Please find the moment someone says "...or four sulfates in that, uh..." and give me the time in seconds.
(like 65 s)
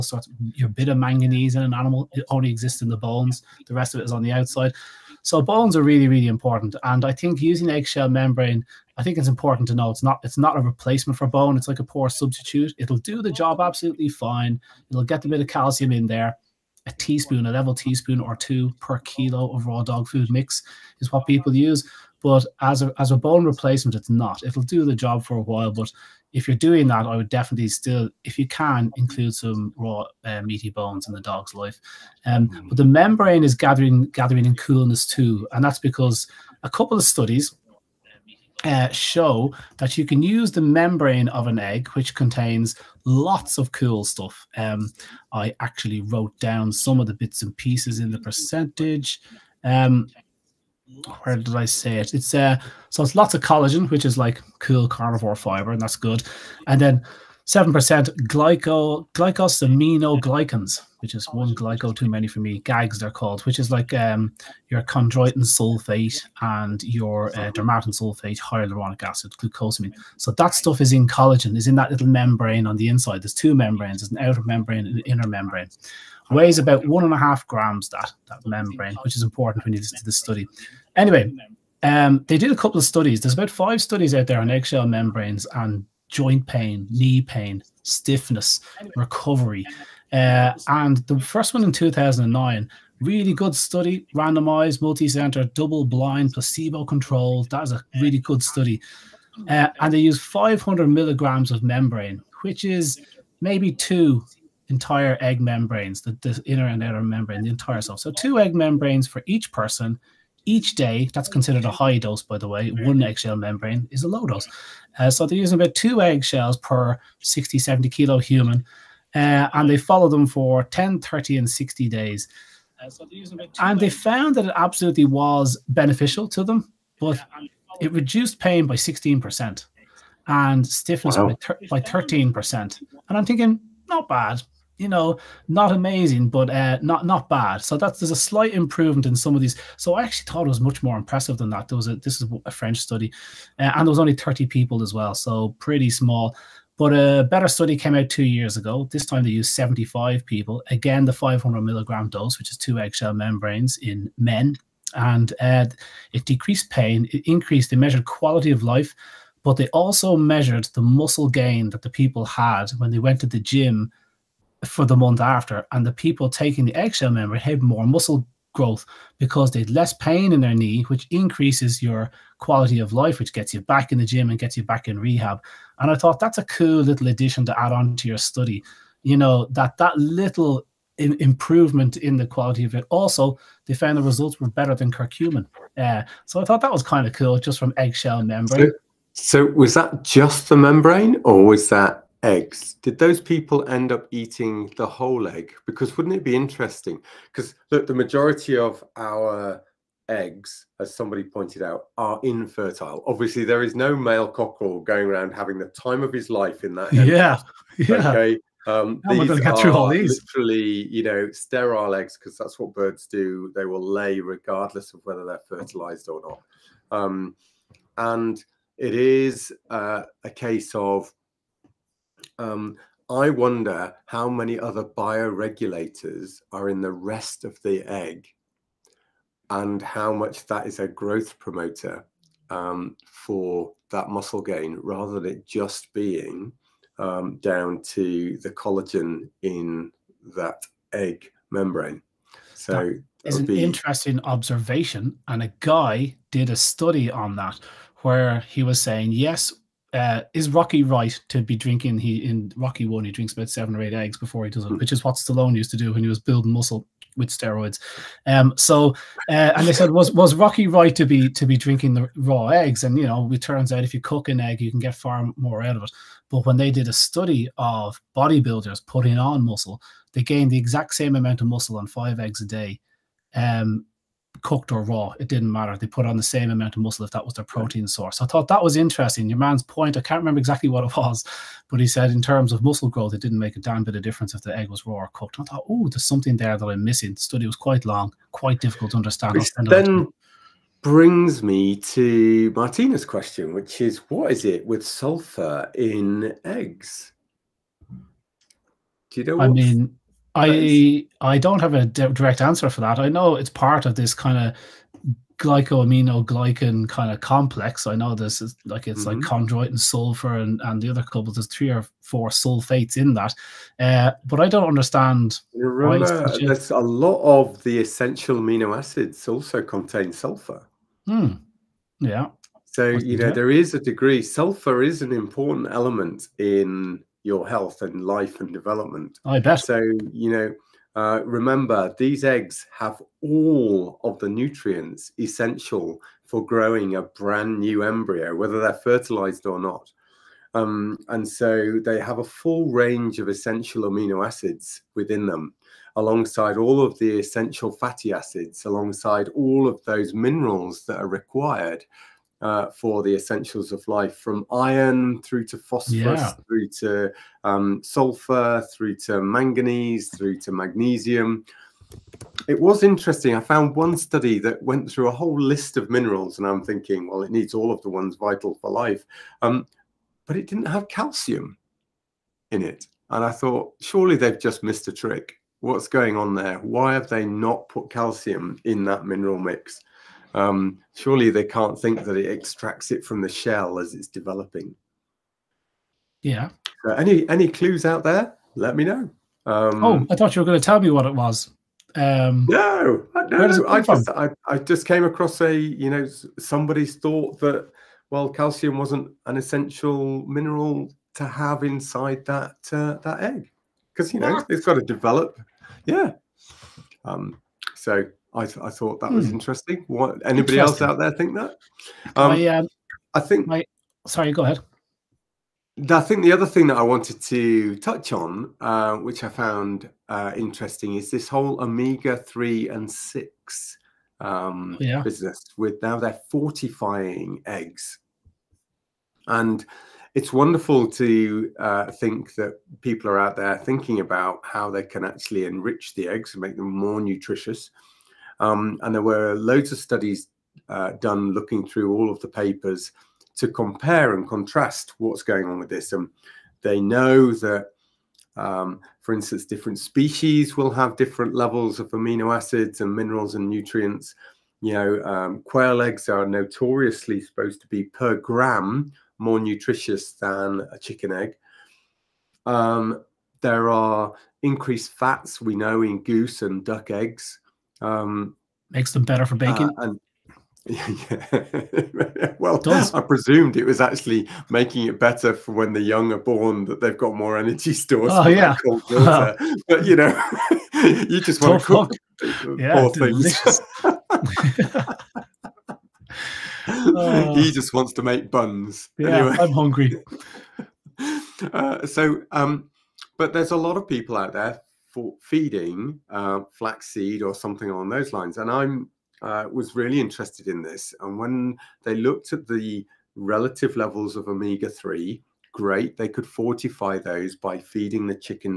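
311 s.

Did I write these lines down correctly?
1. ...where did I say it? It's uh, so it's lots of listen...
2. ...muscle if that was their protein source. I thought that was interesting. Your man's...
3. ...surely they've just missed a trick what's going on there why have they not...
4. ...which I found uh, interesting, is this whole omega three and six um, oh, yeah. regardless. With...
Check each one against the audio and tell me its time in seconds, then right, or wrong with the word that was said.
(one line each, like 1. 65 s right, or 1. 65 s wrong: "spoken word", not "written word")
1. 51 s wrong: "collagen", not "listen"
2. 276 s right
3. 373 s right
4. 418 s wrong: "business", not "regardless".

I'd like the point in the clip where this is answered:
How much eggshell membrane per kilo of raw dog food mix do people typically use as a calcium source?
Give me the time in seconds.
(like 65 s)
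16 s.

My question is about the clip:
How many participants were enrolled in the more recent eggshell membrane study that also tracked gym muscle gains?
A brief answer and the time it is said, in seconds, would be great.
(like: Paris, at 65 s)
75, at 149 s.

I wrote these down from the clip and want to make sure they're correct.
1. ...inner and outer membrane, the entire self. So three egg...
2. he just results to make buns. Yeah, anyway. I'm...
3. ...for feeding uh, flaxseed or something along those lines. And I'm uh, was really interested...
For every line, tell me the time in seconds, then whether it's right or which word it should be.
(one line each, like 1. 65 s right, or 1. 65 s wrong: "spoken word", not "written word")
1. 106 s wrong: "two", not "three"
2. 487 s wrong: "wants", not "results"
3. 494 s right.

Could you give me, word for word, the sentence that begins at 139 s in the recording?
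So I actually thought it was much more impressive than that.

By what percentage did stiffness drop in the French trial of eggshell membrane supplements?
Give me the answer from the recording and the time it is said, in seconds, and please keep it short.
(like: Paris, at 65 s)
13%, at 131 s.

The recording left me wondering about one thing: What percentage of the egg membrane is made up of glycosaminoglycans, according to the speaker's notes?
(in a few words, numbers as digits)
7%.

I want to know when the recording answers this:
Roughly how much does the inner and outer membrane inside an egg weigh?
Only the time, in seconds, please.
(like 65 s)
76 s.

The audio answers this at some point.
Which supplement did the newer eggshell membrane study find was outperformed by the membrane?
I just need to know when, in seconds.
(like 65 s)
184 s.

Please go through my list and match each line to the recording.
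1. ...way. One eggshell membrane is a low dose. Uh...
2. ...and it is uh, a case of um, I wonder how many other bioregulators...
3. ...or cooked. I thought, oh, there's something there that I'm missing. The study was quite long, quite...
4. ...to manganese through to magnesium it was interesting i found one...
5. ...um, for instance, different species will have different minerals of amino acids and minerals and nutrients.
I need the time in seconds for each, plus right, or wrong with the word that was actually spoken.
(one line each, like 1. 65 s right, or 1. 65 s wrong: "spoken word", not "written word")
1. 112 s right
2. 217 s right
3. 284 s right
4. 359 s right
5. 448 s wrong: "levels", not "minerals".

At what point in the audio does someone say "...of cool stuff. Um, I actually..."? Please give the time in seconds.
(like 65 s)
43 s.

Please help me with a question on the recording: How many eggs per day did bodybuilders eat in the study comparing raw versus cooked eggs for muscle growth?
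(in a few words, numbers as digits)
5.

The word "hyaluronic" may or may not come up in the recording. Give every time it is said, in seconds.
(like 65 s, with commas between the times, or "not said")
68 s.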